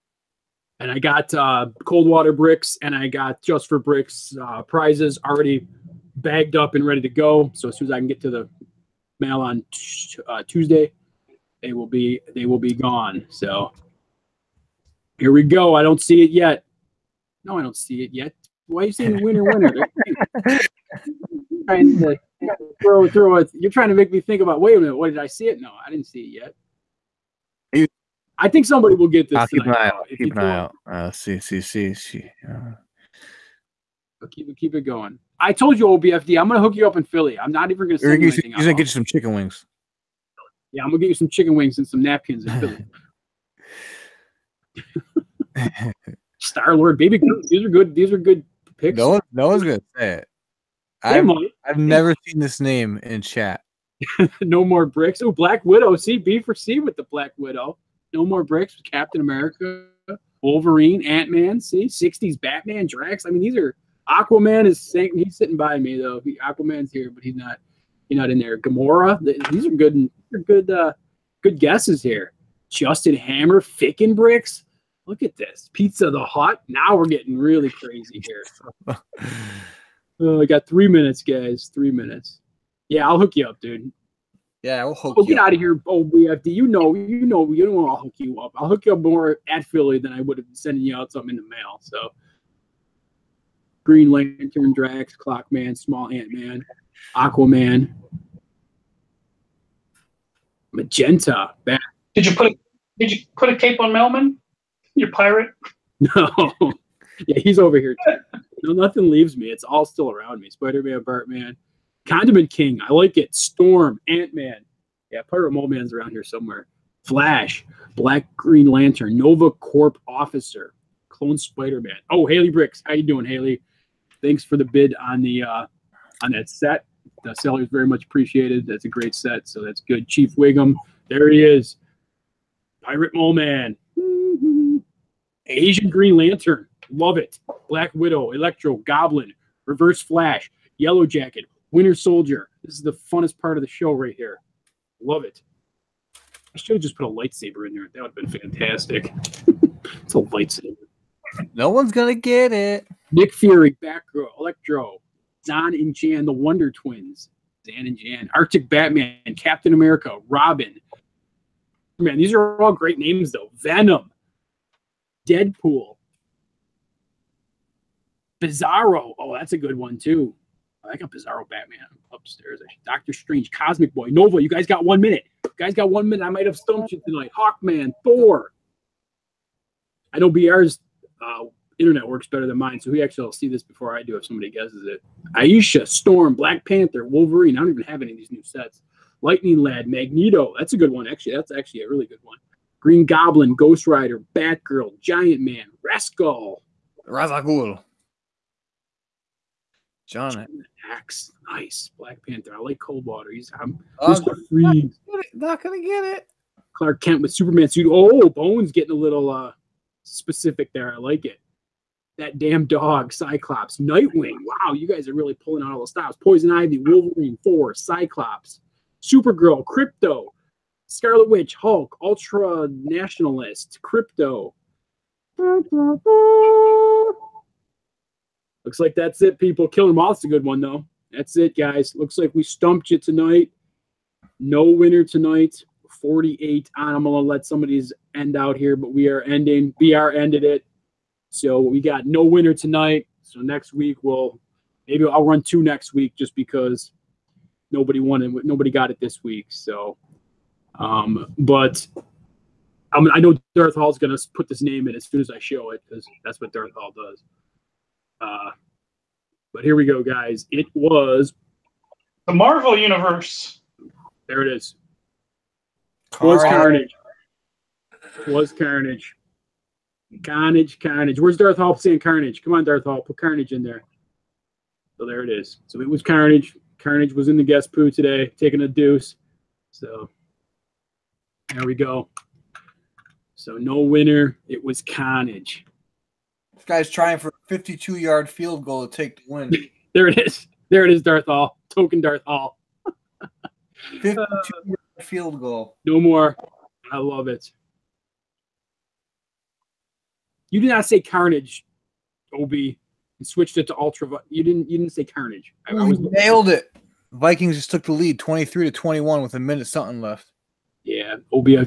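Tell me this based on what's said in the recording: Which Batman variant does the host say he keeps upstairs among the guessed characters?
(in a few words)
Bizarro Batman.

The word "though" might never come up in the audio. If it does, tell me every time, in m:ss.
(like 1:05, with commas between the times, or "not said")
1:05, 2:43, 3:50.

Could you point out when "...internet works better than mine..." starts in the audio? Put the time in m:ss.
3:01.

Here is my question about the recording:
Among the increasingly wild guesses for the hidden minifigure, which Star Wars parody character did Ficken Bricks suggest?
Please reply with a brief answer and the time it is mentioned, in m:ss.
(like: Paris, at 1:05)
Pizza the Hutt, at 1:15.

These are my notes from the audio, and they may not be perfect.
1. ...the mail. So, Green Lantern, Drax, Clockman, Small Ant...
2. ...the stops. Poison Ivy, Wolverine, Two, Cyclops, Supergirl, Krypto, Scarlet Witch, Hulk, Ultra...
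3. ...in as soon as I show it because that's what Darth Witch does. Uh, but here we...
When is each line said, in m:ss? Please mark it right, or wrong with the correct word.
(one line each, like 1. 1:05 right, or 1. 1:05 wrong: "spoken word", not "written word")
1. 1:31 right
2. 3:35 wrong: "Four", not "Two"
3. 4:14 wrong: "Hall", not "Witch".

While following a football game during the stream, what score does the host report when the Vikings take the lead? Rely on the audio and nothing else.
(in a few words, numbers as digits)
23 to 21.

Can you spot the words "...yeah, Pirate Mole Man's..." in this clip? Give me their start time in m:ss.
1:55.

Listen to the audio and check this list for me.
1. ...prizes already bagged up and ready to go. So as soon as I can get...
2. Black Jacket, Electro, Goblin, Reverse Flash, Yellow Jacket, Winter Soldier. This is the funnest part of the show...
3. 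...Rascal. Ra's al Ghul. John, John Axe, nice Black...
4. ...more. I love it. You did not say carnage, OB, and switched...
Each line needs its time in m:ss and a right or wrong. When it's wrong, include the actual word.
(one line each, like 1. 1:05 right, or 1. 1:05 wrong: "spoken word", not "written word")
1. 0:04 right
2. 2:17 wrong: "Widow", not "Jacket"
3. 3:15 right
4. 4:55 right.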